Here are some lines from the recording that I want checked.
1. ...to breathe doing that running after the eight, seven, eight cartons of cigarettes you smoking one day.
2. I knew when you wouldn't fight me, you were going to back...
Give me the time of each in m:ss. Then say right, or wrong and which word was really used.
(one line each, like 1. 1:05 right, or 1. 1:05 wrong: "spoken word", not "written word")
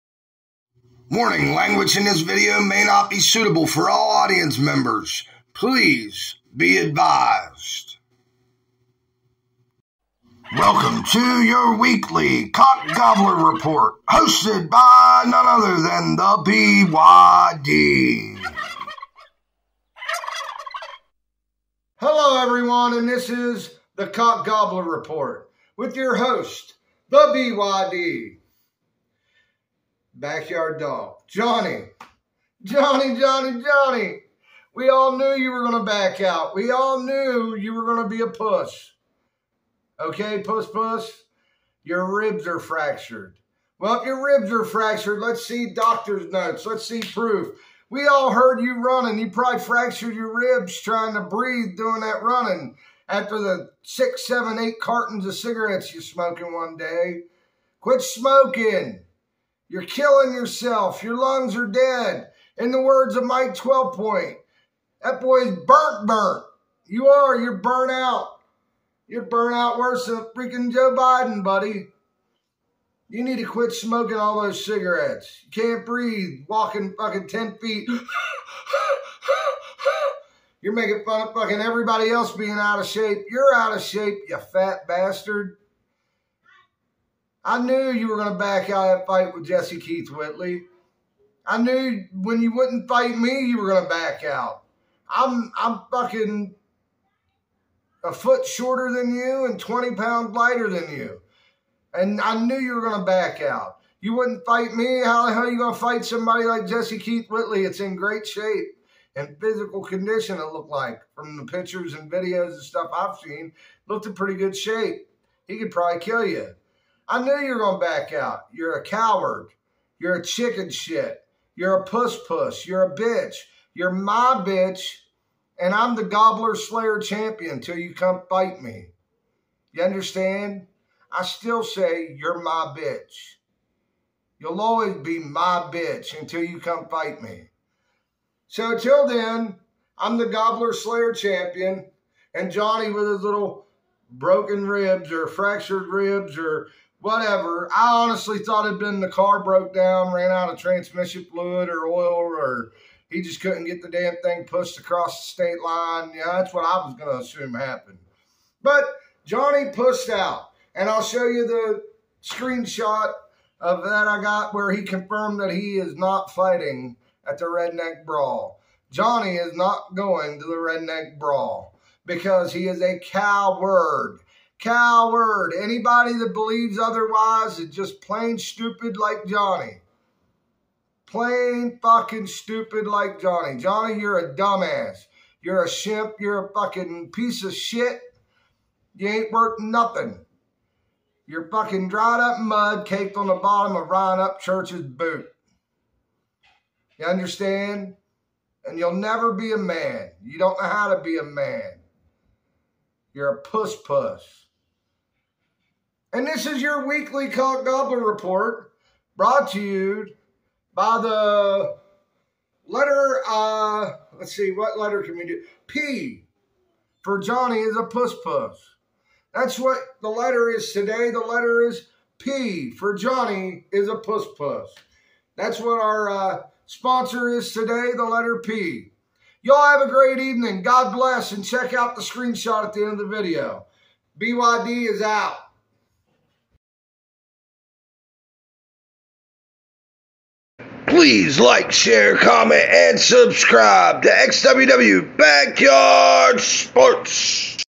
1. 0:51 wrong: "six", not "eight"
2. 1:31 right.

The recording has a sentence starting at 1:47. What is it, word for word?
It's in great shape and physical condition, it looked like, from the pictures and videos and stuff I've seen.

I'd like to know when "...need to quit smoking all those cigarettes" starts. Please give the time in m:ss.
1:13.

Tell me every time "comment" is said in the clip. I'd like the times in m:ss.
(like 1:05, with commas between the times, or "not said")
4:02.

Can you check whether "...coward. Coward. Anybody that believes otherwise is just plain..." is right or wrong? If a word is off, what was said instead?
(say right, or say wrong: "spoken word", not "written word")
right.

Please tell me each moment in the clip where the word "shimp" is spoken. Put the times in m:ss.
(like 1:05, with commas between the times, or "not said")
3:05.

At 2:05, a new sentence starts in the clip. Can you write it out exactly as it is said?
And I'm the gobbler slayer champion till you come fight me.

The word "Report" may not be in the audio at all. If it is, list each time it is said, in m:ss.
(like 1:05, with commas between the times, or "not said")
0:13, 0:24, 3:28.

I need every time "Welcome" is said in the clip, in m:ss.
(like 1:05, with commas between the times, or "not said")
0:10.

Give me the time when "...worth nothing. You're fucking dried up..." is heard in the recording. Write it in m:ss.
3:09.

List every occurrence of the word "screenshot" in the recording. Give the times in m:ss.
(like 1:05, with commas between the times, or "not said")
2:42, 3:52.